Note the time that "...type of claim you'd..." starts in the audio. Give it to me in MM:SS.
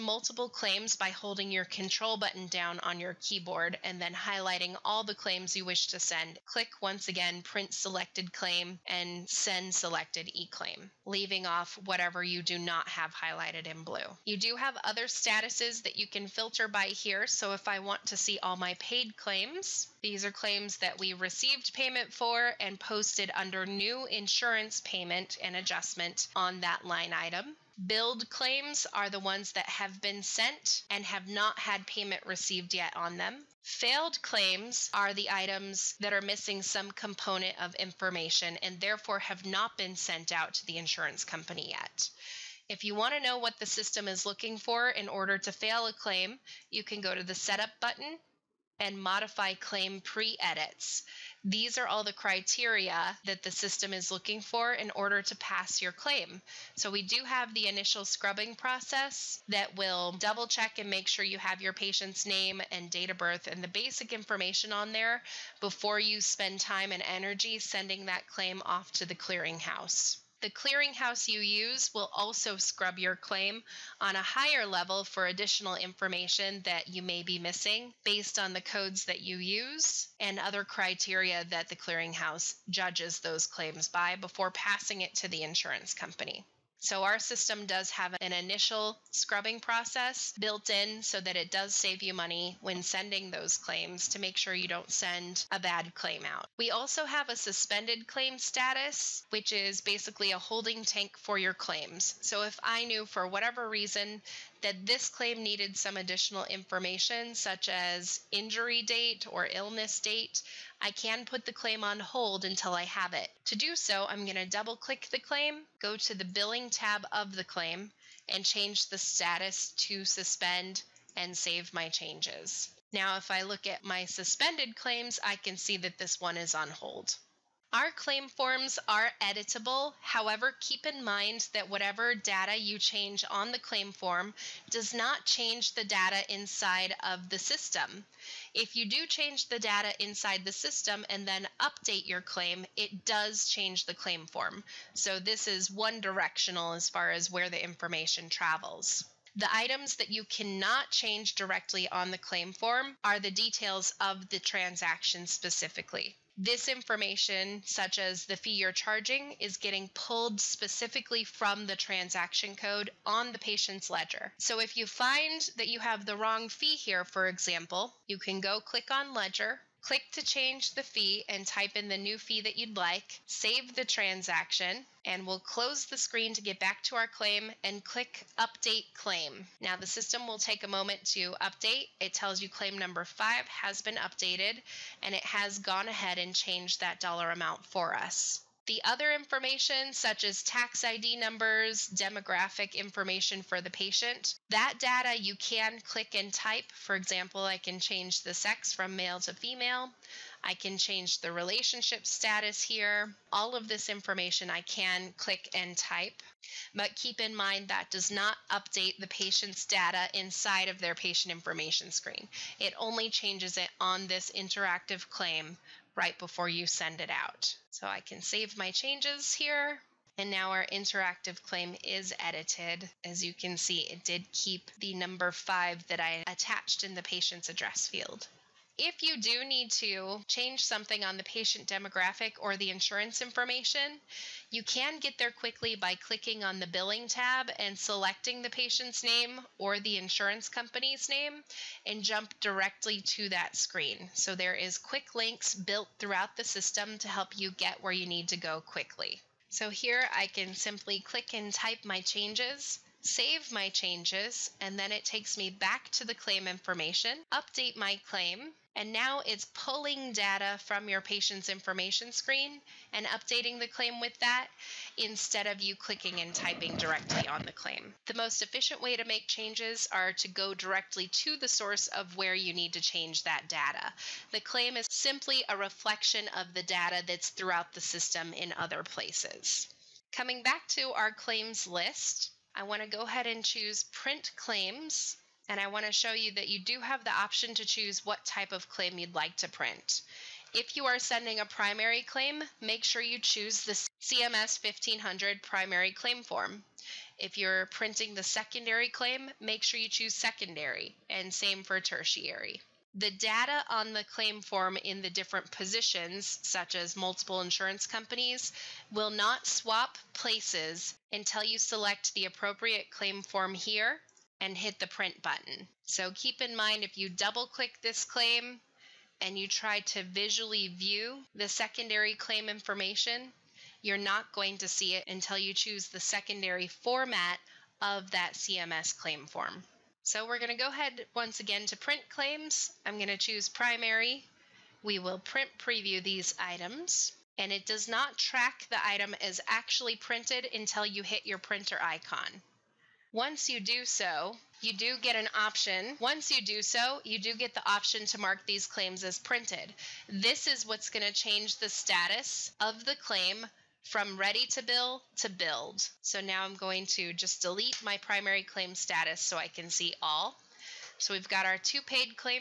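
04:48.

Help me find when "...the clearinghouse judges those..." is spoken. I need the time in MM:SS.
01:21.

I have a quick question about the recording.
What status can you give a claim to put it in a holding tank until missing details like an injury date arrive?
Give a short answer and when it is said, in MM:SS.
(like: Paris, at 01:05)
Suspend, at 02:00.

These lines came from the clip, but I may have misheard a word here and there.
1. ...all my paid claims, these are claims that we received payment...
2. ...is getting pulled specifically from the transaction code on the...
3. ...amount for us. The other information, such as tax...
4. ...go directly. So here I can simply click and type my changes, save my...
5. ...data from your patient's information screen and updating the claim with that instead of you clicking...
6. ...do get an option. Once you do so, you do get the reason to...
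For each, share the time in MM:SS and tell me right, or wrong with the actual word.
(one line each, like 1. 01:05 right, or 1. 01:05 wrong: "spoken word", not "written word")
1. 00:18 right
2. 02:39 right
3. 03:07 right
4. 04:08 wrong: "quickly", not "directly"
5. 04:20 right
6. 05:44 wrong: "option", not "reason".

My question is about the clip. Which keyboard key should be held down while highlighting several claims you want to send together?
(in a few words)
Control.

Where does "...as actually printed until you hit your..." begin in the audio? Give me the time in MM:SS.
05:39.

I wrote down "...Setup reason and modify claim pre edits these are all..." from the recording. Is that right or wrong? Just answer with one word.
wrong.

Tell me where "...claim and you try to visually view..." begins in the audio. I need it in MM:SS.
05:18.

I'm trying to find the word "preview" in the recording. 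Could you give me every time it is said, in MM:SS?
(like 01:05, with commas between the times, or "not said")
05:35.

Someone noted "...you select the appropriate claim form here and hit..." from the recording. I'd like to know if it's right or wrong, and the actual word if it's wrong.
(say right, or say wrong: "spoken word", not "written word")
right.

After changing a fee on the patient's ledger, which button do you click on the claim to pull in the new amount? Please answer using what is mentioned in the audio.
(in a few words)
Update Claim.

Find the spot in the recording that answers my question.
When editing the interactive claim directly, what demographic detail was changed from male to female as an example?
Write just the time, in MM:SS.
03:18.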